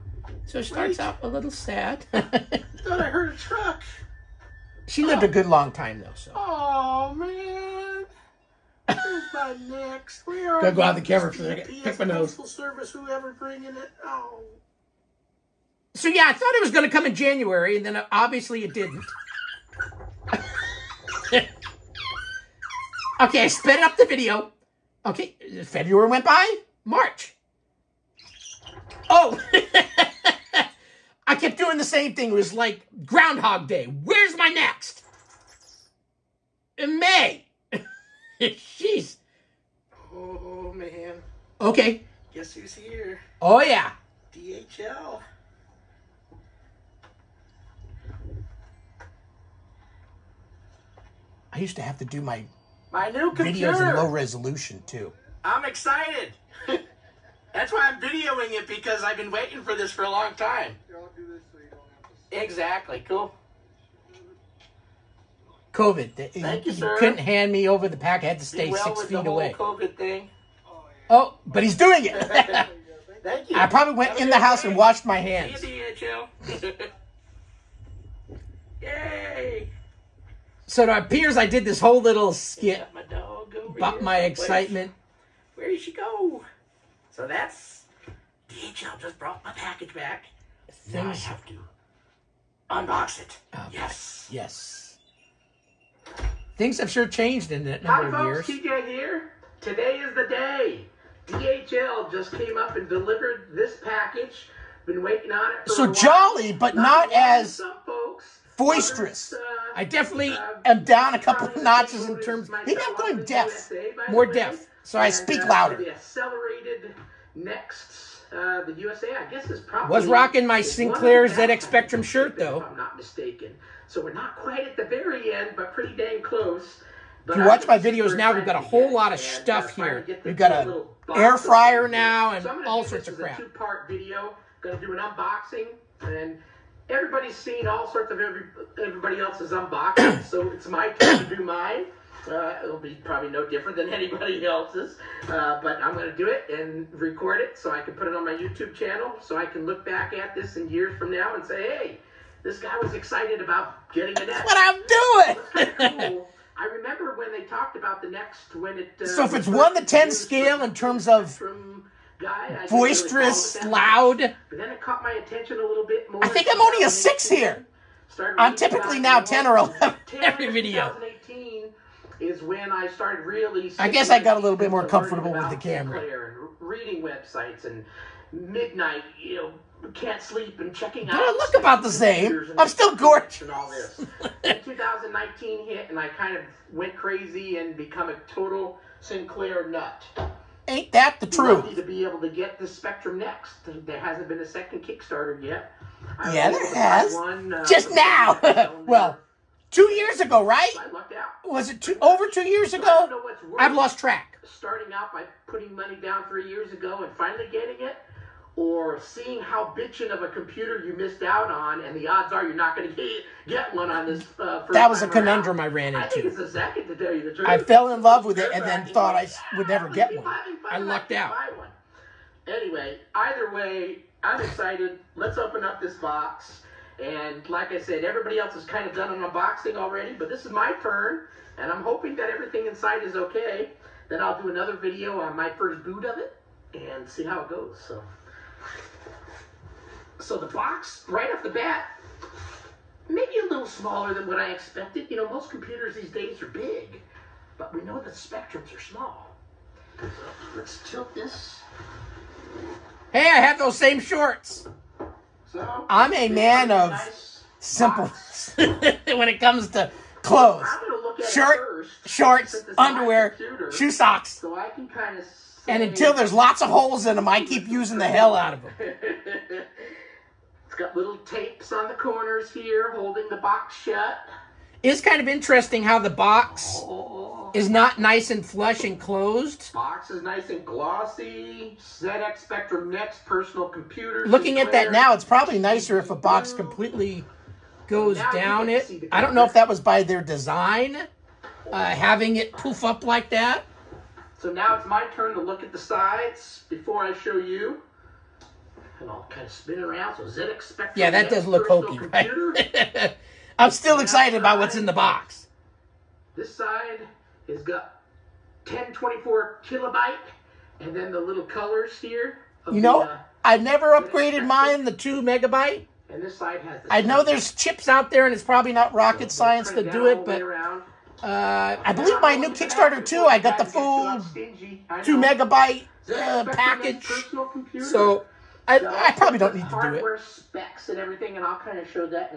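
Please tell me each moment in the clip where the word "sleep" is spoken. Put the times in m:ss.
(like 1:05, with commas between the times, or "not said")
3:00.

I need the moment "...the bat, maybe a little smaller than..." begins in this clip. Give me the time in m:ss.
4:01.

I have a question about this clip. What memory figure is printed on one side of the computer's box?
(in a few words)
1024 kilobyte.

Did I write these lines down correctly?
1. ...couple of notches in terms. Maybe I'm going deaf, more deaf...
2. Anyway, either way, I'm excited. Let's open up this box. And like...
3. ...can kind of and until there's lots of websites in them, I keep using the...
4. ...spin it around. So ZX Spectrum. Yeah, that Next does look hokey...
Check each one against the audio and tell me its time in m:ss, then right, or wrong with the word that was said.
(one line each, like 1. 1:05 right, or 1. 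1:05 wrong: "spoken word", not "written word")
1. 1:51 right
2. 3:42 right
3. 4:24 wrong: "holes", not "websites"
4. 4:59 right.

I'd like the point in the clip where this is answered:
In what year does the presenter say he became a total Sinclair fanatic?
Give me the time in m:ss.
3:04.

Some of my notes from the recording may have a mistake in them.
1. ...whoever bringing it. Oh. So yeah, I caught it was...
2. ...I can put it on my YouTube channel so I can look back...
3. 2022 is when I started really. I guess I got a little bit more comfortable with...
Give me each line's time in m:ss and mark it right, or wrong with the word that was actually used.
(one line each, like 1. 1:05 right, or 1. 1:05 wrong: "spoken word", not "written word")
1. 0:12 wrong: "thought", not "caught"
2. 2:27 right
3. 2:50 wrong: "2018", not "2022".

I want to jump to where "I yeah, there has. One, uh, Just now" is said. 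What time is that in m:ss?
3:16.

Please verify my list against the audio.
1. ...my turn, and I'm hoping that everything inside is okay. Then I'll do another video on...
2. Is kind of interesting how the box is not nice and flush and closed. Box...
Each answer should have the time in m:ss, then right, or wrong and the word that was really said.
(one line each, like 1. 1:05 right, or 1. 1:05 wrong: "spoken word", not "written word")
1. 3:50 right
2. 4:34 right.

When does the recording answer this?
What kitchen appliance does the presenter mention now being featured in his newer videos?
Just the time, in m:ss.
2:11.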